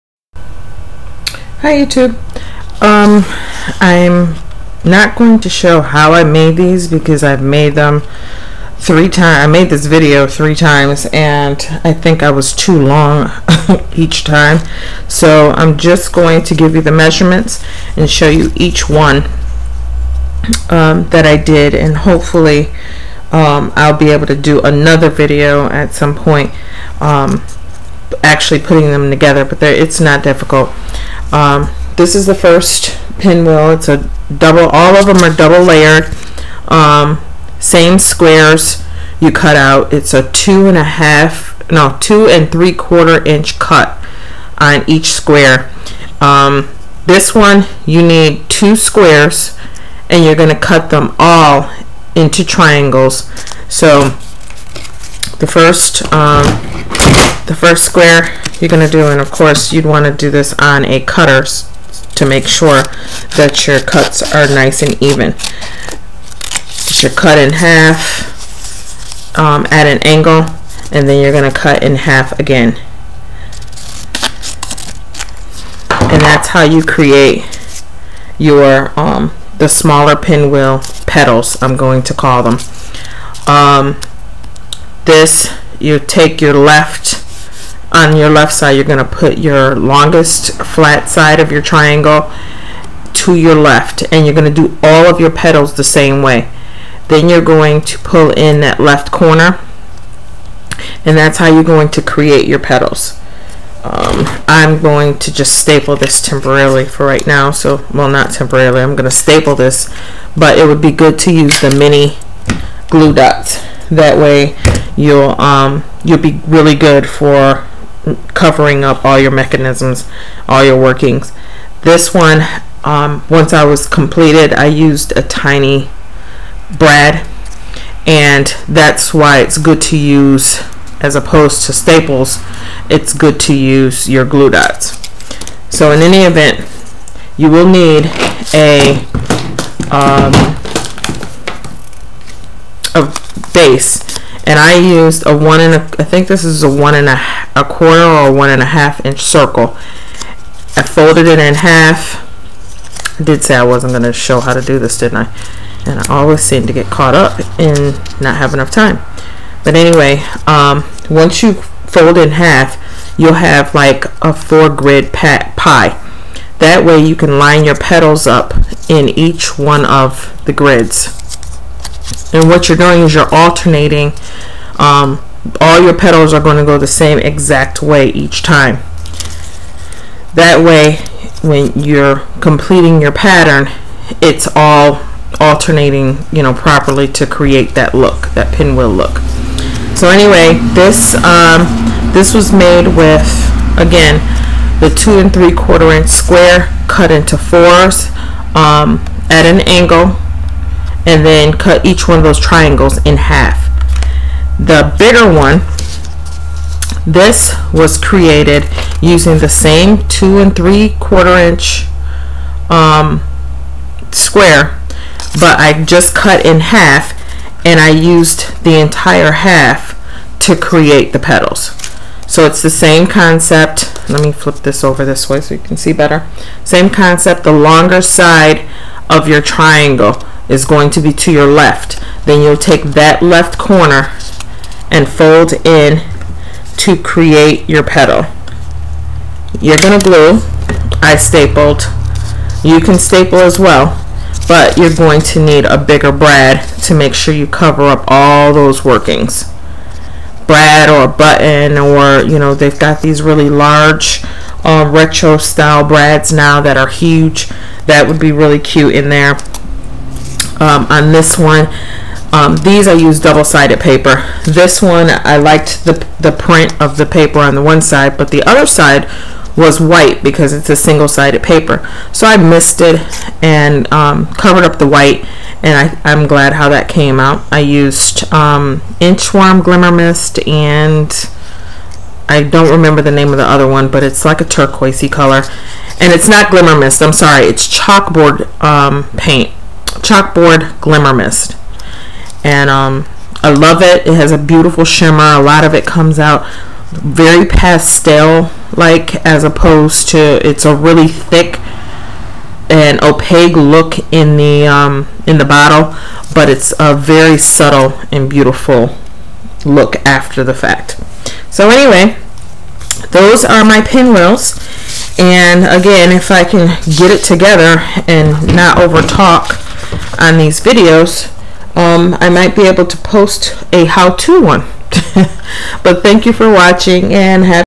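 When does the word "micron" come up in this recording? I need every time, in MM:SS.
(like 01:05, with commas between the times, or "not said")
not said.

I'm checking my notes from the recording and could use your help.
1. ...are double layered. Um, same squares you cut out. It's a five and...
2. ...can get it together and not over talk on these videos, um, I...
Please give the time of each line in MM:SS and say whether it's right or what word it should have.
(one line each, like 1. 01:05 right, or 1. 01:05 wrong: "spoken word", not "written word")
1. 00:35 wrong: "two", not "five"
2. 05:16 right.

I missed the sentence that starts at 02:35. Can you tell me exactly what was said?
And I always seem to get caught up in not having enough time.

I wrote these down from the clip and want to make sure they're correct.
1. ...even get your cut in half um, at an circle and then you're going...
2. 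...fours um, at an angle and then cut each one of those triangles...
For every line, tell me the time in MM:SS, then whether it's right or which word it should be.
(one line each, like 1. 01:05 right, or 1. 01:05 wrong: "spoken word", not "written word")
1. 01:05 wrong: "angle", not "circle"
2. 03:17 right.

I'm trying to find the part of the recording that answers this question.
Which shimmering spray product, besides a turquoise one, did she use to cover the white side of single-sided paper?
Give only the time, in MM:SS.
04:39.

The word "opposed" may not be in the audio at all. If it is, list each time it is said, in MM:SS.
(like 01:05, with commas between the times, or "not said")
02:11, 04:59.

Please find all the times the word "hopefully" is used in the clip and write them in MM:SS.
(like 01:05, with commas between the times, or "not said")
00:21.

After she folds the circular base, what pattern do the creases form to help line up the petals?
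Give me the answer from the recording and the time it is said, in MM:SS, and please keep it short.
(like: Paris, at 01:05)
four grid pie, at 02:44.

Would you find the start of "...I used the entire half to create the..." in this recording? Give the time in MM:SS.
03:37.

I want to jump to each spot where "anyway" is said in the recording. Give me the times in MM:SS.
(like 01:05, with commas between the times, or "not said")
02:39, 03:10, 05:11.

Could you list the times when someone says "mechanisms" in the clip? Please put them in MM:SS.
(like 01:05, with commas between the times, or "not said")
01:59.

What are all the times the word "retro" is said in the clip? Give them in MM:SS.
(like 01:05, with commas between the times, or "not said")
04:14.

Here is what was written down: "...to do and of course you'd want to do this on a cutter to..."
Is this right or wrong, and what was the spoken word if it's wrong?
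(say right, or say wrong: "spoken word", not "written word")
right.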